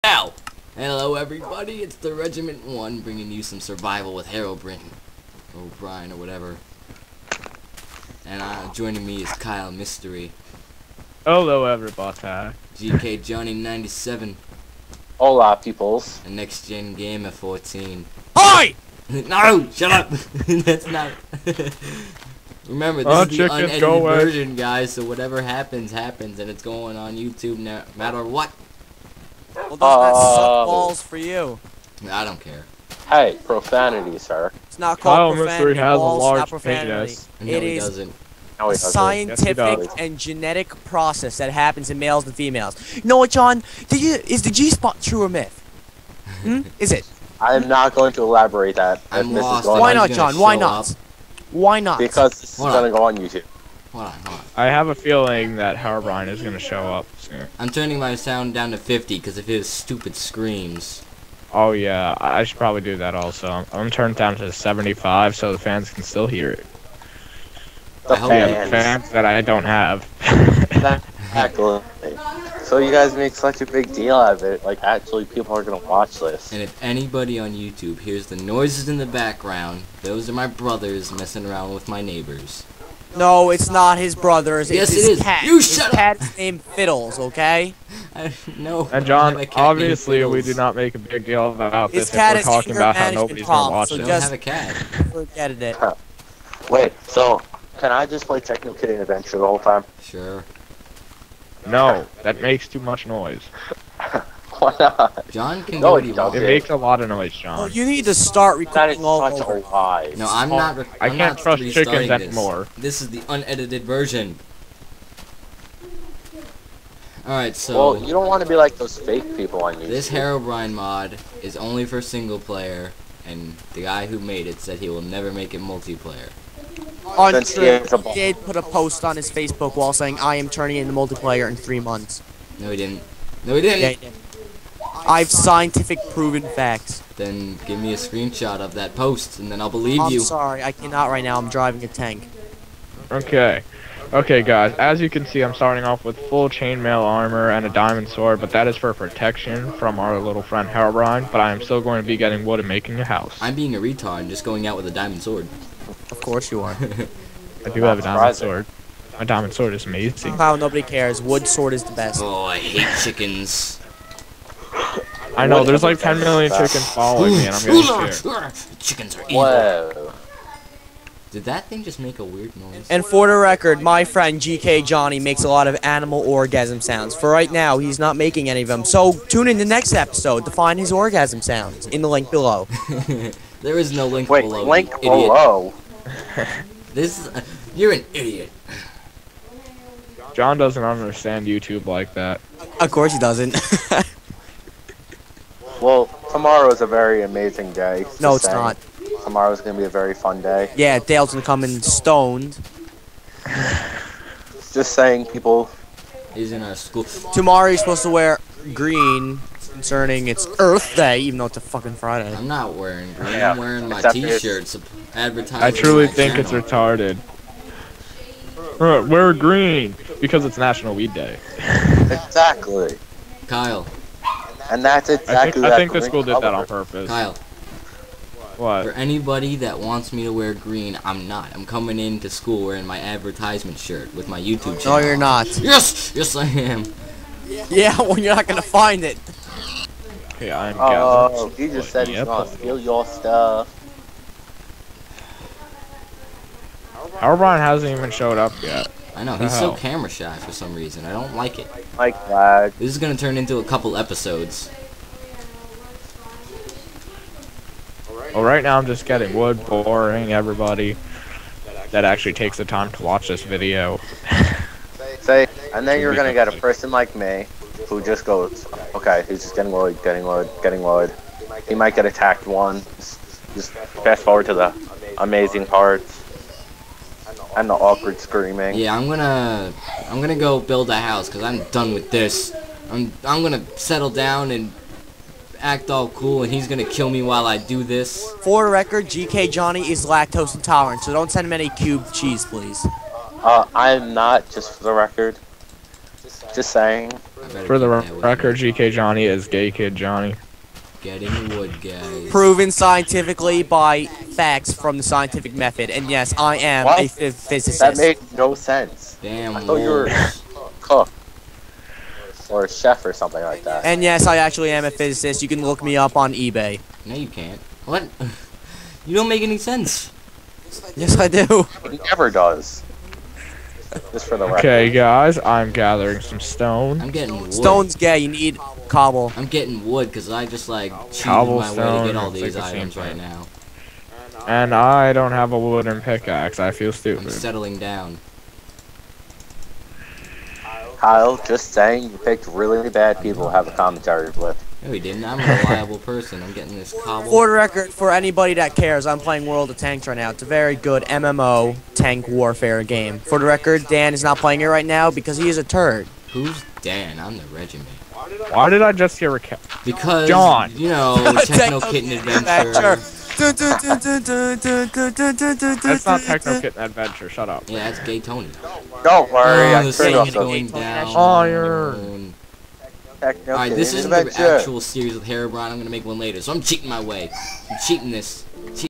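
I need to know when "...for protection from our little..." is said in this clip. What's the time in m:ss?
2:28.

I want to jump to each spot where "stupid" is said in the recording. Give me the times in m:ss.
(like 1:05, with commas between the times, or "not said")
0:59, 5:36.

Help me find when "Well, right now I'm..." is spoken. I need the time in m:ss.
4:18.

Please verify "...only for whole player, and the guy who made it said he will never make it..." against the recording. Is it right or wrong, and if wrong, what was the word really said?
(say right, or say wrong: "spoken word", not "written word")
wrong: "single", not "whole".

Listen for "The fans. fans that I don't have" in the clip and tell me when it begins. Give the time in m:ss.
1:08.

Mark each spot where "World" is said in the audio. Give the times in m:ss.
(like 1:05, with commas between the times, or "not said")
5:49.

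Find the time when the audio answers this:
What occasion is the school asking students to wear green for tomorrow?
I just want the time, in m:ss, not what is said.
3:30.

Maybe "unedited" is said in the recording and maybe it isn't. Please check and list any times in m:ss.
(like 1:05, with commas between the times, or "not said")
0:23, 1:53.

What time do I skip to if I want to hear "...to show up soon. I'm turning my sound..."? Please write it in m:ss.
0:56.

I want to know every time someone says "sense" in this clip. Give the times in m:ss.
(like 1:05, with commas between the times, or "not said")
5:08, 5:19.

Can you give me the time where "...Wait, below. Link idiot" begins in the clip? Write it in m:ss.
3:04.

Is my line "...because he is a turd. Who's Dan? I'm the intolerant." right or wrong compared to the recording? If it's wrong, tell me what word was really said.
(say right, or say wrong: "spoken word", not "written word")
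wrong: "regiment", not "intolerant".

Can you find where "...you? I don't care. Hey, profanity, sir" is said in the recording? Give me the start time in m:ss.
0:31.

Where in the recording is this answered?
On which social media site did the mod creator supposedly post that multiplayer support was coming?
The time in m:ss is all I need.
2:09.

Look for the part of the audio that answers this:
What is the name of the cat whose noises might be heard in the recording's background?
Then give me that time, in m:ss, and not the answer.
1:26.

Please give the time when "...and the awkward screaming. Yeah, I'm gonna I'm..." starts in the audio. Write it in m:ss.
4:37.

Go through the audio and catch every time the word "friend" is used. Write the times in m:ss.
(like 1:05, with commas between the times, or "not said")
2:30, 2:54.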